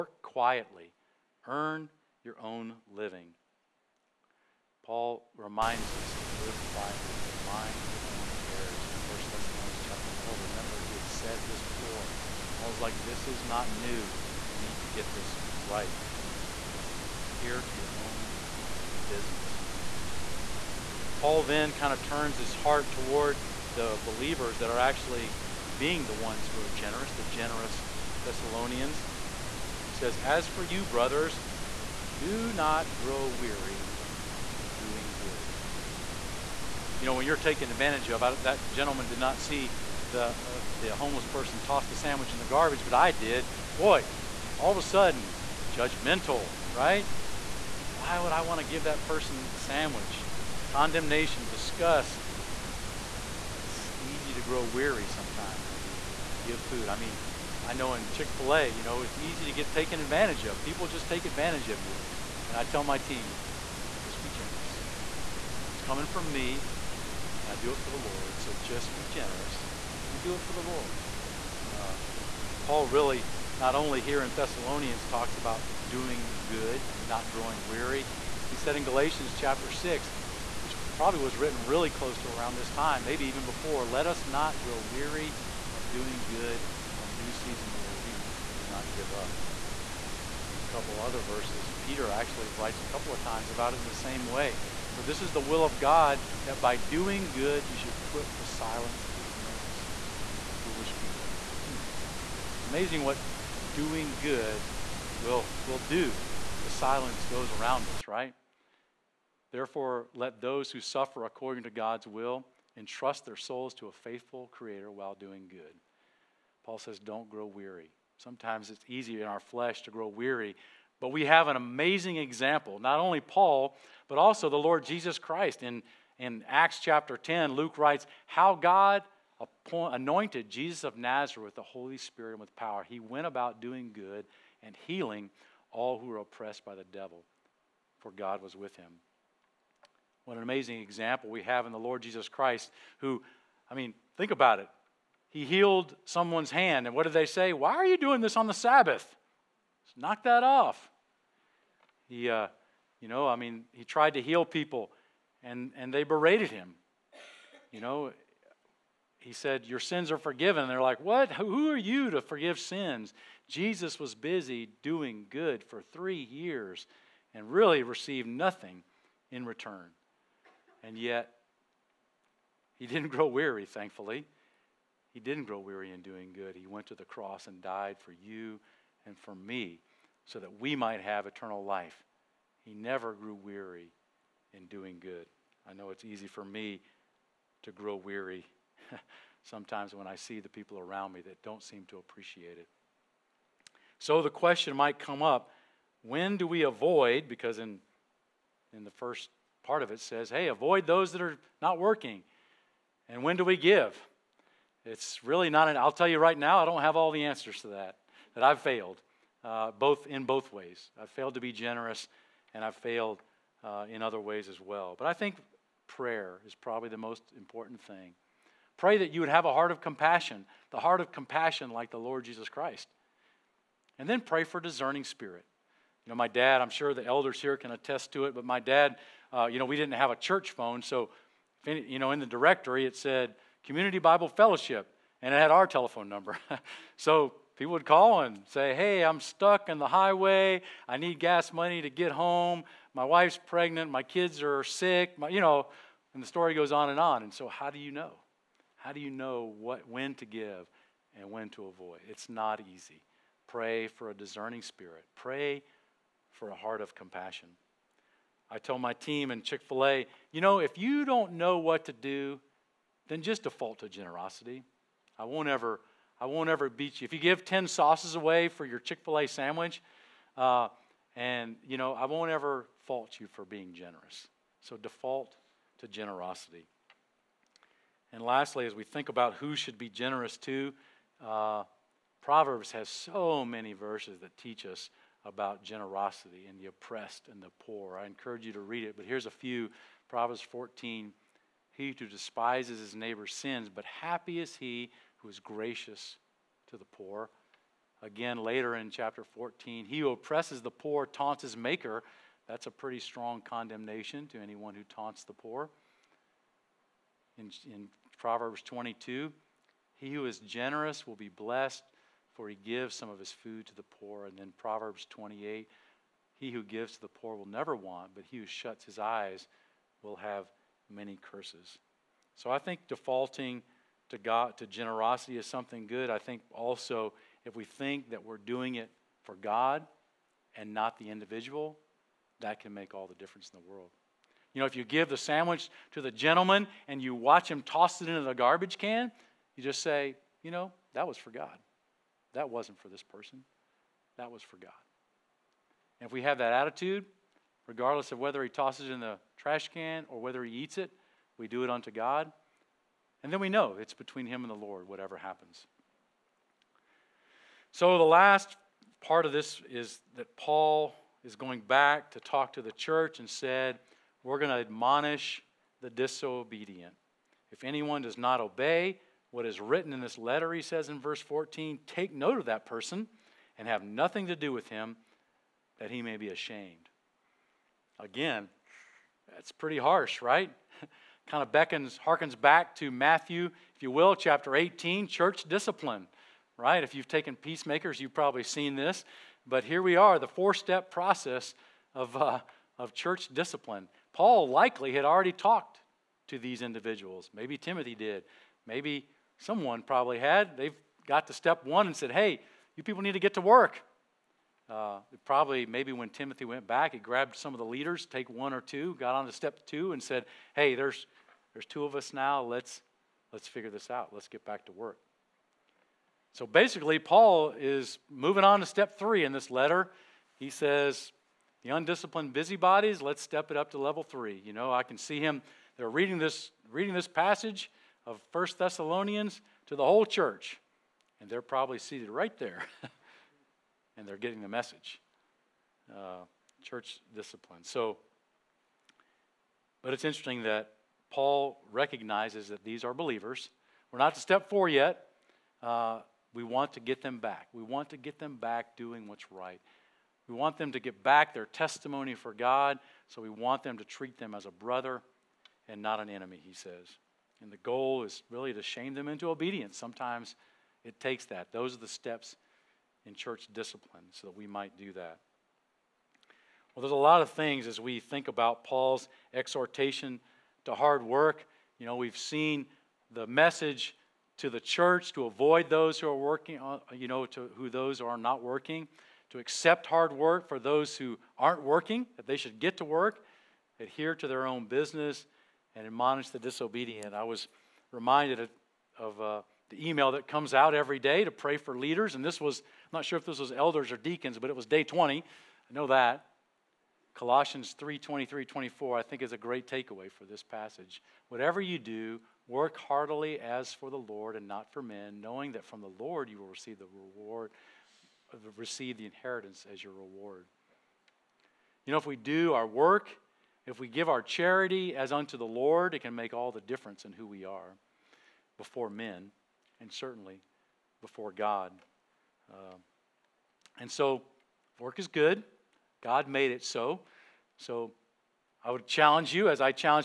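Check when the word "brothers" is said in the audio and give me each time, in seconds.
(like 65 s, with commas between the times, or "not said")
30 s, 454 s.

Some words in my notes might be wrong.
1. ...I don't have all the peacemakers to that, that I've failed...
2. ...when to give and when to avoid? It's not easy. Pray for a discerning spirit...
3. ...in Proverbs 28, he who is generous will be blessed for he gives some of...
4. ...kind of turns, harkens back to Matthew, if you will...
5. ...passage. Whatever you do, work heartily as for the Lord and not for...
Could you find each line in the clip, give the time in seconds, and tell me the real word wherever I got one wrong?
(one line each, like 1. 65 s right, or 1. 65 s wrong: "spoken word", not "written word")
1. 206 s wrong: "answers", not "peacemakers"
2. 249 s right
3. 307 s wrong: "22", not "28"
4. 381 s wrong: "beckons", not "turns"
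5. 500 s right.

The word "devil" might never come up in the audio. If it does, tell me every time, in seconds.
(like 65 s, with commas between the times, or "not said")
136 s.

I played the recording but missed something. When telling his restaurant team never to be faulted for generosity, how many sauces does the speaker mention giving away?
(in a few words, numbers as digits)
10.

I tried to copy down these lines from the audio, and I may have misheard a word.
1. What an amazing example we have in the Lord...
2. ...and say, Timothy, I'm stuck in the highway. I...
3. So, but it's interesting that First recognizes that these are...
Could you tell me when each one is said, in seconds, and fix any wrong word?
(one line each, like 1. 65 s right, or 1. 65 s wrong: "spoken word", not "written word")
1. 140 s right
2. 238 s wrong: "Hey", not "Timothy"
3. 437 s wrong: "Paul", not "First".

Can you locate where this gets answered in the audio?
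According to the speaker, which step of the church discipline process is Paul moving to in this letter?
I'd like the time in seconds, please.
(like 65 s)
418 s.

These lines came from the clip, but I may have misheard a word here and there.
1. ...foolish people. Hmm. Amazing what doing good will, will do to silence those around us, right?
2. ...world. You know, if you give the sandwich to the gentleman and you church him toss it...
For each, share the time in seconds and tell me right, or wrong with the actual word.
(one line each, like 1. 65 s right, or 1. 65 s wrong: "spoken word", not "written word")
1. 100 s right
2. 333 s wrong: "watch", not "church".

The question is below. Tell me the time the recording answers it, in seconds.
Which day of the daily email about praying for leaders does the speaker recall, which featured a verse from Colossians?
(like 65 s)
494 s.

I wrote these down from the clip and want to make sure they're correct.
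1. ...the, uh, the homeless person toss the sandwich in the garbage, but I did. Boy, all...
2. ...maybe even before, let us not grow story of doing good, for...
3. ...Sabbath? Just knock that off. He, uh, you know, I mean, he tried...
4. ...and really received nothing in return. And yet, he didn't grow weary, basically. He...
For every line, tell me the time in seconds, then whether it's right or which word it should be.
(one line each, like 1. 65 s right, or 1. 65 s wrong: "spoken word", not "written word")
1. 40 s right
2. 83 s wrong: "weary", not "story"
3. 148 s right
4. 167 s wrong: "thankfully", not "basically".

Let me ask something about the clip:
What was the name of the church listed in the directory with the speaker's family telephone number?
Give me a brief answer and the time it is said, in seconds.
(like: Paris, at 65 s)
Community Bible Fellowship, at 233 s.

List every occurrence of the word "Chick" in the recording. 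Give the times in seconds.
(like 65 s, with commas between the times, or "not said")
58 s, 259 s, 268 s.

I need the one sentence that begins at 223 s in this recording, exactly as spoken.
And then pray for discerning spirit.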